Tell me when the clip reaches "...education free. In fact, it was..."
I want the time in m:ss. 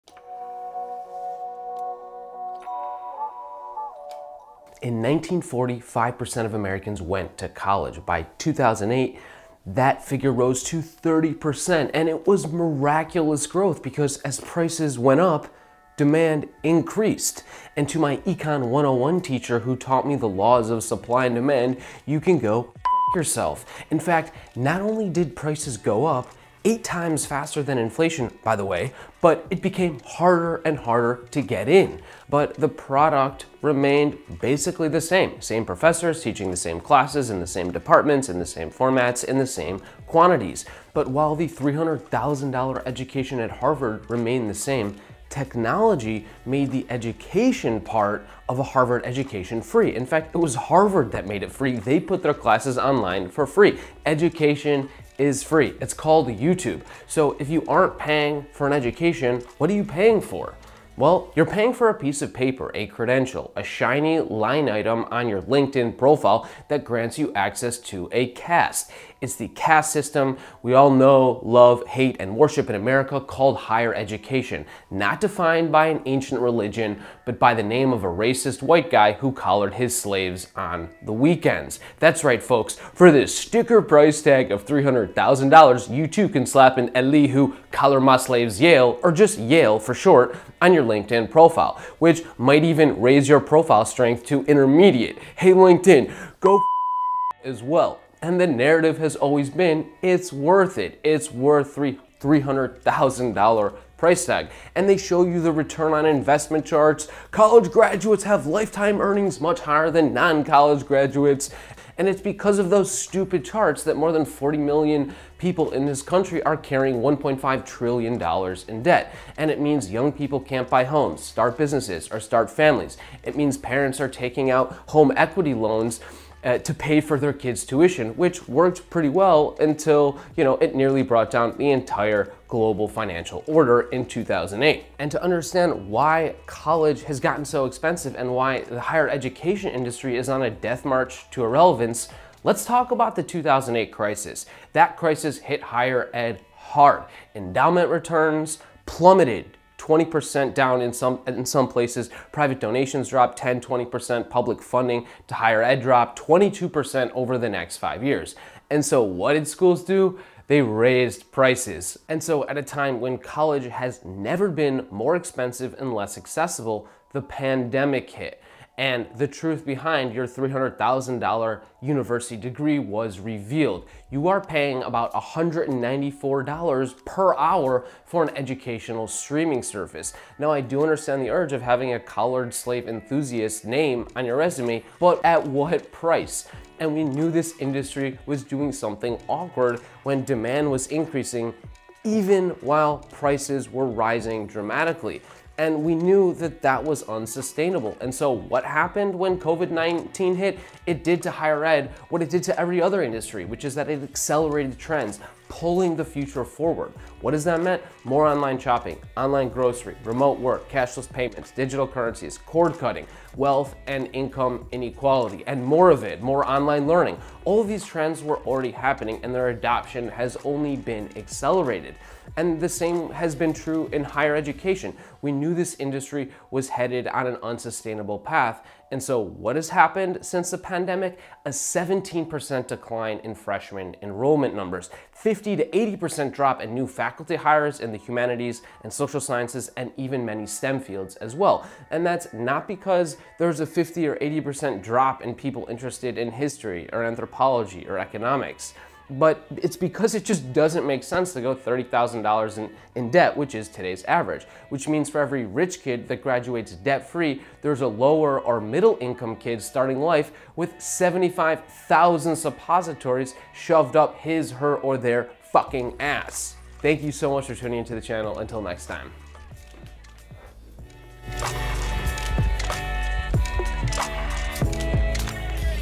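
0:49.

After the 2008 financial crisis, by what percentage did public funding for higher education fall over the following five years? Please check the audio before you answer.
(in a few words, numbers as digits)
22%.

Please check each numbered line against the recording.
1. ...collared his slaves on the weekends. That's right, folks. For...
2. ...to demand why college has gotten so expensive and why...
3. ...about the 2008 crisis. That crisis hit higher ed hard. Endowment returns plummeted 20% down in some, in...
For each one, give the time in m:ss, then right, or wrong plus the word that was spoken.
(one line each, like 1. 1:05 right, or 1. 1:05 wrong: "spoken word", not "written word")
1. 1:19 right
2. 2:15 wrong: "understand", not "demand"
3. 2:22 right.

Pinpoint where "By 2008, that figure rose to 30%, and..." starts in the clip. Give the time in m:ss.
0:08.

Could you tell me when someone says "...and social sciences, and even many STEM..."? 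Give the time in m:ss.
3:58.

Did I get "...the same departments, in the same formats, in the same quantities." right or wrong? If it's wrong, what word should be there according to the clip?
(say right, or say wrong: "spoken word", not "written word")
right.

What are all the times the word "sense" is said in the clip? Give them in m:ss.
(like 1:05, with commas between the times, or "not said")
4:11.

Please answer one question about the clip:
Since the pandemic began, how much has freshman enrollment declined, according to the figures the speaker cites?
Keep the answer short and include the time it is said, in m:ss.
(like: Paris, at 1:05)
17%, at 3:51.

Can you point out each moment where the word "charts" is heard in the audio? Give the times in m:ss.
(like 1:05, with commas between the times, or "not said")
1:46, 1:53.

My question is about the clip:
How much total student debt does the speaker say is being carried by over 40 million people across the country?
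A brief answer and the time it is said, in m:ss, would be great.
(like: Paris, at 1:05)
$1.5 trillion, at 1:57.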